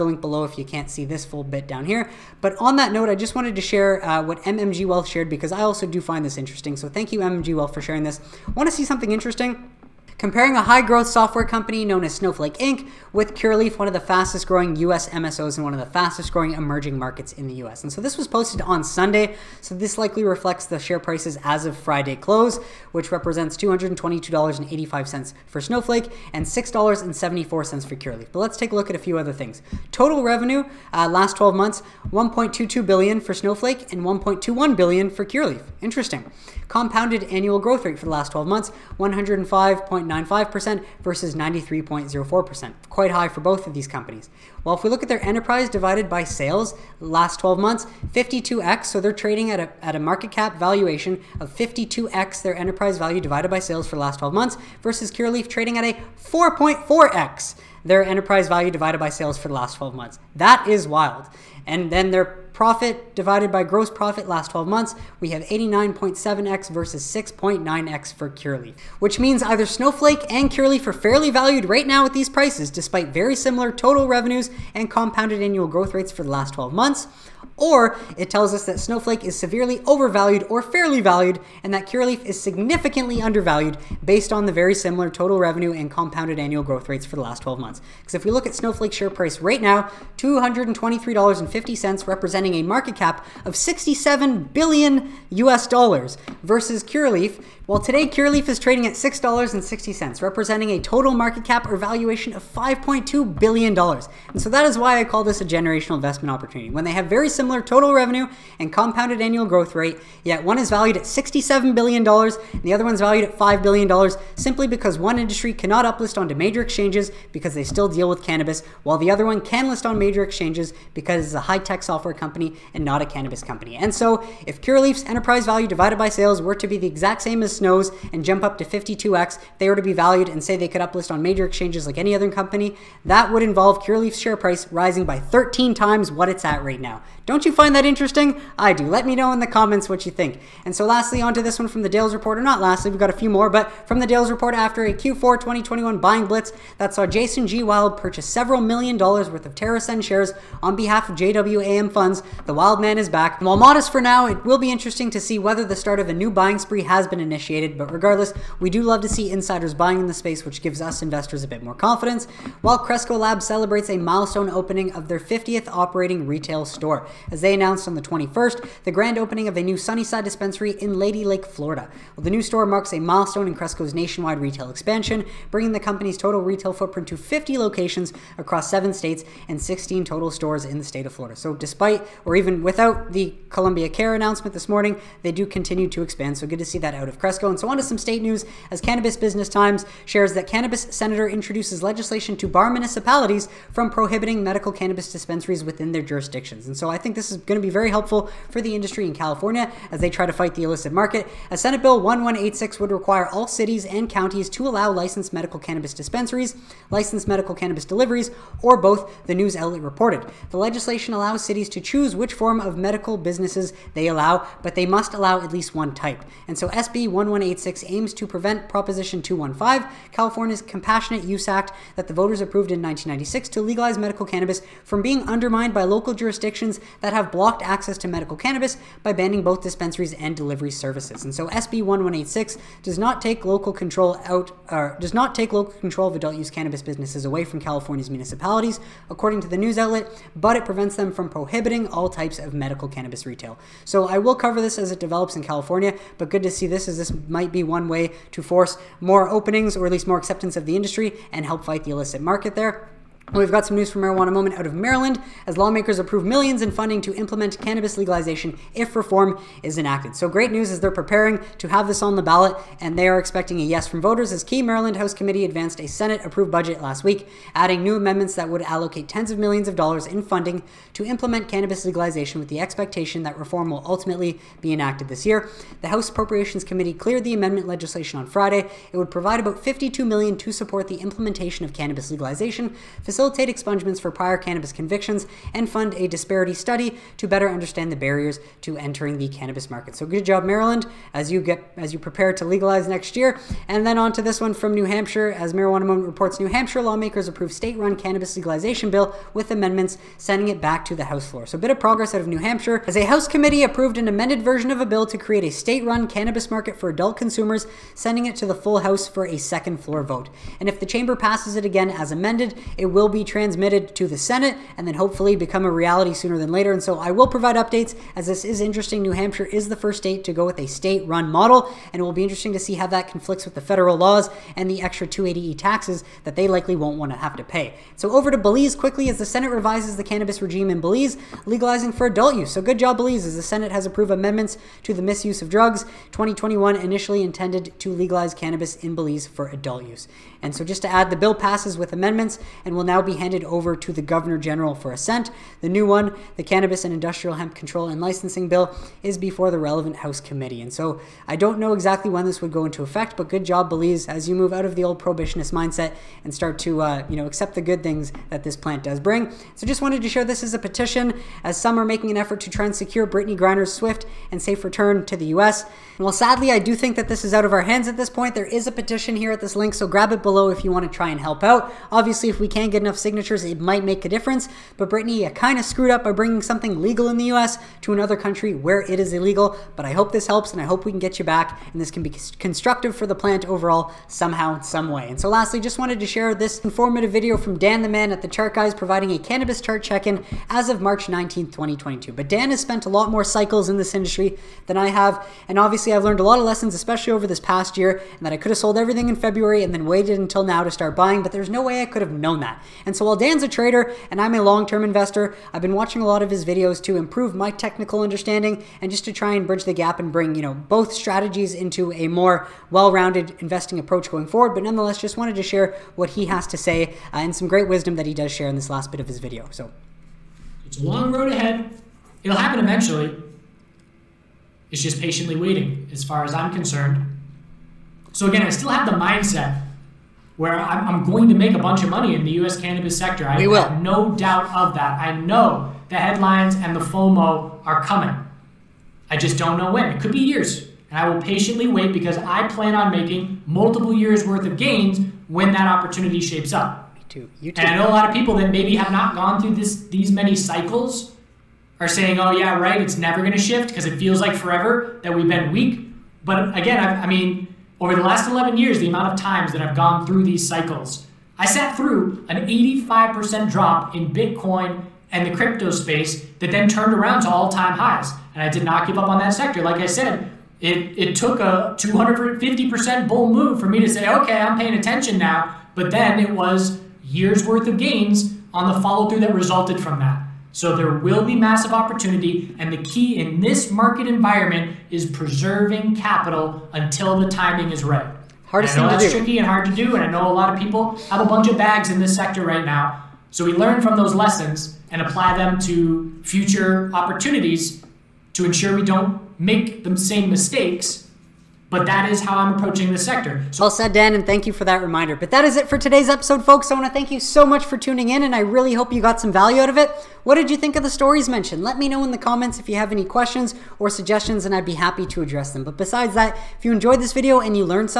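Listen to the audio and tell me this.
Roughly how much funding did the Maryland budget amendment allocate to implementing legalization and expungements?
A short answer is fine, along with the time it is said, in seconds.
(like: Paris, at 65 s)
$52 million, at 279 s.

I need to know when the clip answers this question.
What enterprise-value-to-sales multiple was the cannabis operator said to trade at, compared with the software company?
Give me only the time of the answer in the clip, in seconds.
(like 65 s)
56 s.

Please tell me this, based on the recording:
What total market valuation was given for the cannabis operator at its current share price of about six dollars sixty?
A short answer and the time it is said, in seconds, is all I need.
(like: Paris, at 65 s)
$5.2 billion, at 102 s.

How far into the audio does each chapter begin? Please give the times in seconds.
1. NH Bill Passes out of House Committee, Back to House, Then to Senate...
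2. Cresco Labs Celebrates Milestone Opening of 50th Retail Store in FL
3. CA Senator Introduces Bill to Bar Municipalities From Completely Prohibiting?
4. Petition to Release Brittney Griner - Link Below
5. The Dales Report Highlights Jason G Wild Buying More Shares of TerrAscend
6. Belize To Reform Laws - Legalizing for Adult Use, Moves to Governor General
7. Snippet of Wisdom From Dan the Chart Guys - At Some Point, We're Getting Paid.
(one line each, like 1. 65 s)
1. 295 s
2. 163 s
3. 187 s
4. 358 s
5. 140 s
6. 328 s
7. 385 s.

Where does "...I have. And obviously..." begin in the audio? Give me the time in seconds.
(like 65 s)
394 s.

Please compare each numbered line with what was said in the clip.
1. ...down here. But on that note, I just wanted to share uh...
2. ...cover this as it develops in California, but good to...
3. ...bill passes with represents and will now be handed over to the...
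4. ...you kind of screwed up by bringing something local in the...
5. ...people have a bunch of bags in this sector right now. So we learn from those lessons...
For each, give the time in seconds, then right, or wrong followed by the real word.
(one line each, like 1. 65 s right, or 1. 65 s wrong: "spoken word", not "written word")
1. 1 s right
2. 244 s right
3. 341 s wrong: "amendments", not "represents"
4. 375 s wrong: "legal", not "local"
5. 490 s right.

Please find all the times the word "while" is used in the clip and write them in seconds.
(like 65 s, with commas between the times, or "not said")
118 s, 153 s, 162 s, 366 s, 403 s.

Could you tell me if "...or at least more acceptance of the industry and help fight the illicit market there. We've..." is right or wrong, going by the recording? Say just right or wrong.
right.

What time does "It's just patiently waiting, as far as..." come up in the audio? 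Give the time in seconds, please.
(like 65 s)
424 s.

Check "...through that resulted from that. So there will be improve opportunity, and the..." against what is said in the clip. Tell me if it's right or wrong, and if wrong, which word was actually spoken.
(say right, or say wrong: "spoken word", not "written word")
wrong: "massive", not "improve".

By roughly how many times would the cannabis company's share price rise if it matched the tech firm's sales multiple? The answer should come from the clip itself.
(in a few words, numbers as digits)
13.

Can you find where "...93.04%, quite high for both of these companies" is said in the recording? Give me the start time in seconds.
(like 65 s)
41 s.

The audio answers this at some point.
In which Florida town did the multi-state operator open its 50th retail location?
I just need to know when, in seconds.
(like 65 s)
170 s.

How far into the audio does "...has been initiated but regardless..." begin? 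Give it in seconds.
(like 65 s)
156 s.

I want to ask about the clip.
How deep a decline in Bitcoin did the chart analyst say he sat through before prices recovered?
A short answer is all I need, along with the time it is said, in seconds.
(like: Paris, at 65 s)
85%, at 462 s.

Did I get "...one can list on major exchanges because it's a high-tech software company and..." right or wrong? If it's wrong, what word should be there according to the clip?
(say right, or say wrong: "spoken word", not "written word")
right.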